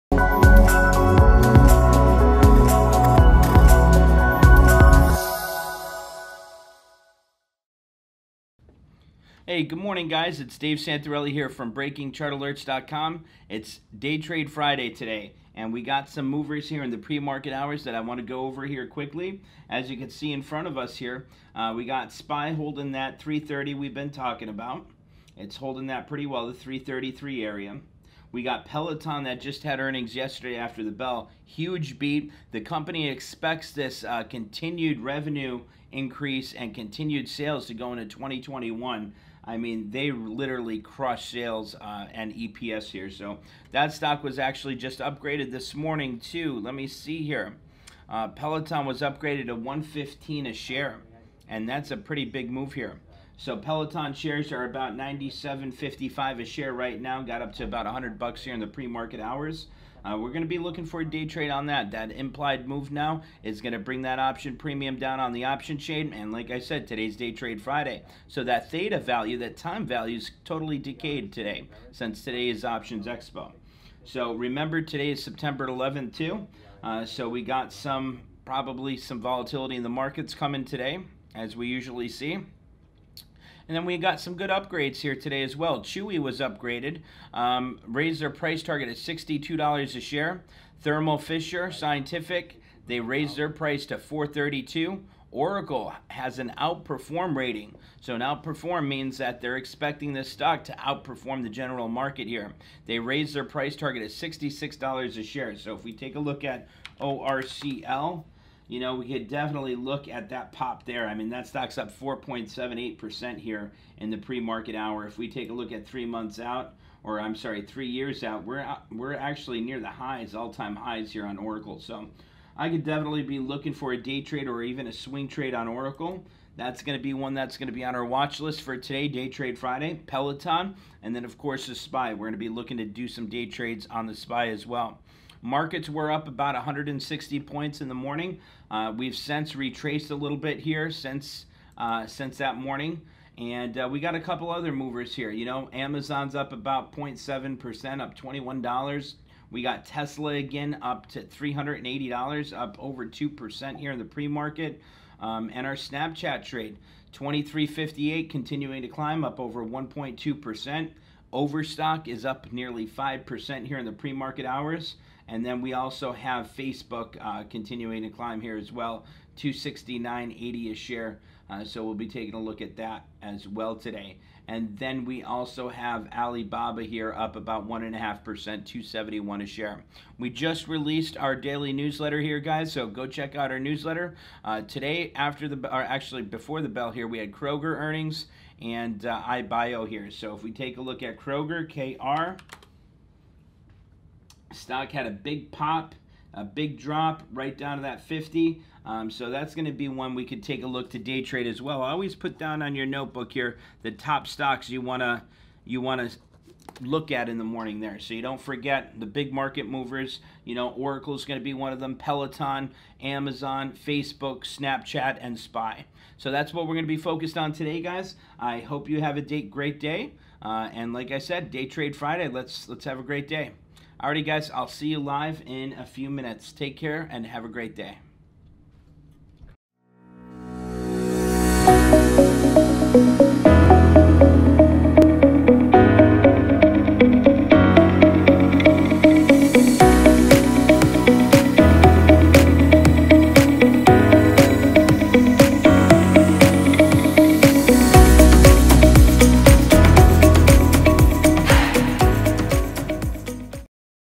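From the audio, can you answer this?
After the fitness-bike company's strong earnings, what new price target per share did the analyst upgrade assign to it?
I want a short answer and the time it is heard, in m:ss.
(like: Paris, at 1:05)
$115, at 0:49.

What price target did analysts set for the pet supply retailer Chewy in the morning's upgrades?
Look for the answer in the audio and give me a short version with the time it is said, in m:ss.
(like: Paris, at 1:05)
$62, at 1:28.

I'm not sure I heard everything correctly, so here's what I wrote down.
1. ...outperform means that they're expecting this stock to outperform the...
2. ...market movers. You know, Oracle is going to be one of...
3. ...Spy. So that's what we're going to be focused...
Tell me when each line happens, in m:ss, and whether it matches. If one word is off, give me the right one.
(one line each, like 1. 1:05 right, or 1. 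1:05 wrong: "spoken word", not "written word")
1. 1:38 right
2. 3:29 right
3. 3:35 right.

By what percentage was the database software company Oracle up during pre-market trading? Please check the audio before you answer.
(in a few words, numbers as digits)
4.78%.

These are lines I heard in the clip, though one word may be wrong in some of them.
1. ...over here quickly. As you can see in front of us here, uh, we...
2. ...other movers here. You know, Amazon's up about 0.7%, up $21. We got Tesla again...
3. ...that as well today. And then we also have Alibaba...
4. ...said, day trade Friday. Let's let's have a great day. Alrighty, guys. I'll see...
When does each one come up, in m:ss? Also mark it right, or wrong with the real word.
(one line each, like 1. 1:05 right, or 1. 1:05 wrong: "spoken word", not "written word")
1. 0:18 right
2. 2:24 right
3. 2:52 right
4. 3:41 right.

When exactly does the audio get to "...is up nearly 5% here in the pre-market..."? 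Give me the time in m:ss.
2:42.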